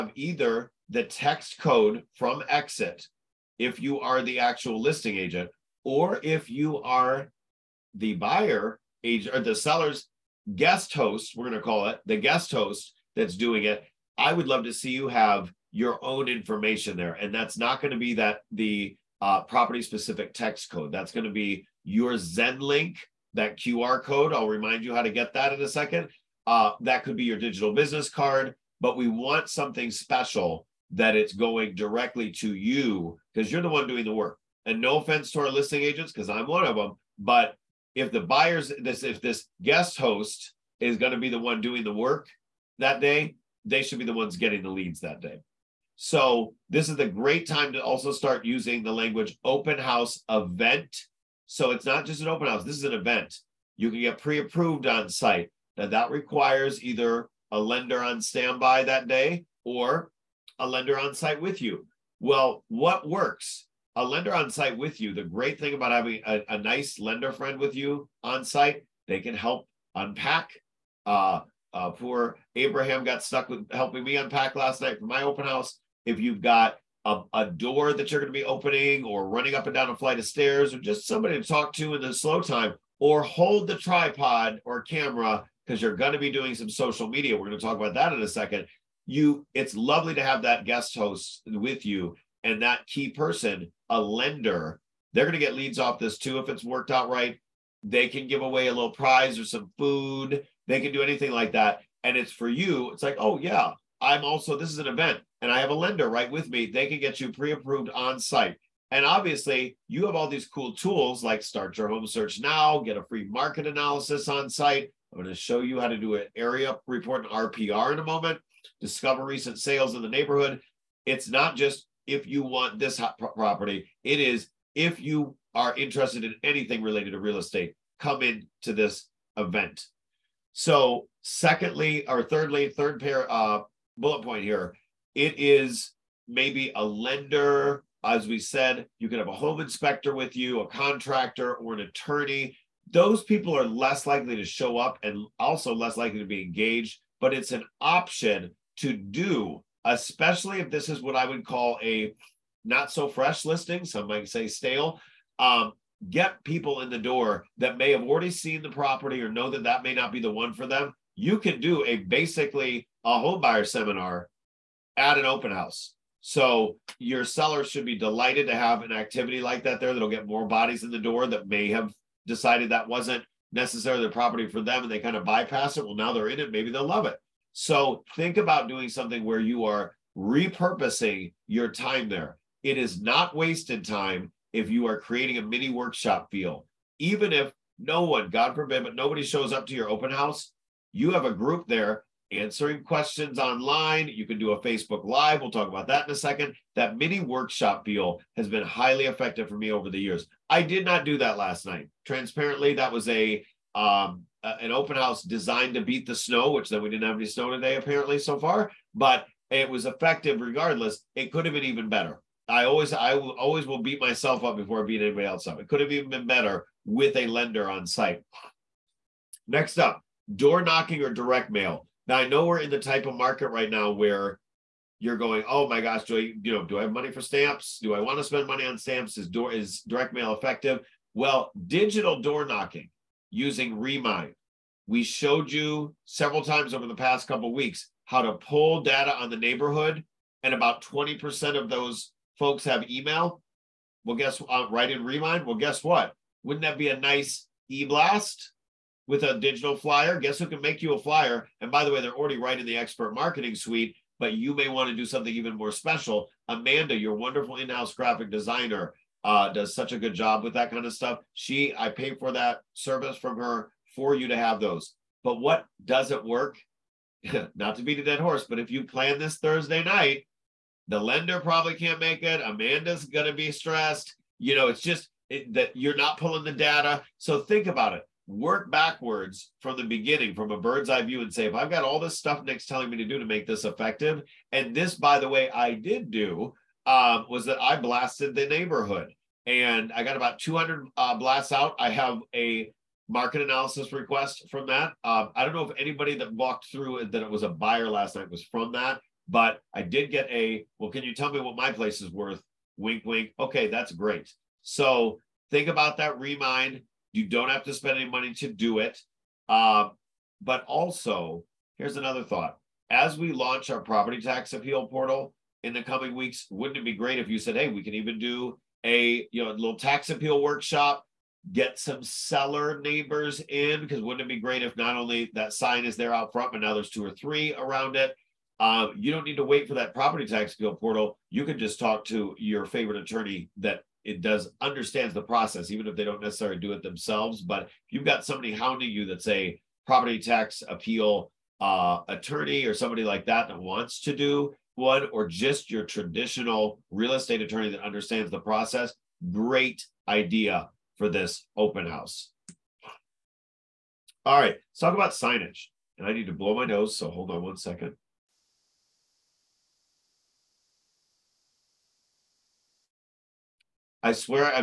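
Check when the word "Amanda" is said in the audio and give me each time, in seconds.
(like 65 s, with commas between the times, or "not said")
256 s, 272 s.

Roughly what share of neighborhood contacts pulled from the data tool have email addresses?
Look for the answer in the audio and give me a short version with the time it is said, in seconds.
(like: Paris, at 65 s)
20%, at 240 s.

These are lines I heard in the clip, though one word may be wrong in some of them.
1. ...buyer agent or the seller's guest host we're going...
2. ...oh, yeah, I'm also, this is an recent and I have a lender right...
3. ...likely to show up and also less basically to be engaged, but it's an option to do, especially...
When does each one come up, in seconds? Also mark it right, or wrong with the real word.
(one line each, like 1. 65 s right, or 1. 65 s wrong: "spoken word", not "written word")
1. 8 s right
2. 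103 s wrong: "event", not "recent"
3. 144 s wrong: "likely", not "basically".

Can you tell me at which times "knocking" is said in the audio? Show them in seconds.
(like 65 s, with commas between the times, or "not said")
220 s, 232 s.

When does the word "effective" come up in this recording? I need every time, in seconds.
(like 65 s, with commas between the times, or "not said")
199 s, 209 s, 230 s, 283 s.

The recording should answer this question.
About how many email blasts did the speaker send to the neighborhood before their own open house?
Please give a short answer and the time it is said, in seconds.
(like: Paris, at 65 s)
200, at 290 s.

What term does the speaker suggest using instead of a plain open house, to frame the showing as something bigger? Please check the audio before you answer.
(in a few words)
open house event.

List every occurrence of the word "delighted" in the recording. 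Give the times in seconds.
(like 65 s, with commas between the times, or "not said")
167 s.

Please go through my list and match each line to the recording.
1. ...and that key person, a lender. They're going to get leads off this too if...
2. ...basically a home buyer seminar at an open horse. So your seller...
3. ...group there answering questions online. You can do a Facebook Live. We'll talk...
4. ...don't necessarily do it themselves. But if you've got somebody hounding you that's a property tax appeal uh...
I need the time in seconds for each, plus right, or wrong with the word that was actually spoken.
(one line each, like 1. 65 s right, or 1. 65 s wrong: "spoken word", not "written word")
1. 92 s right
2. 161 s wrong: "house", not "horse"
3. 191 s right
4. 336 s right.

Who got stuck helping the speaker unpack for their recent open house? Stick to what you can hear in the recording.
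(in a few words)
Abraham.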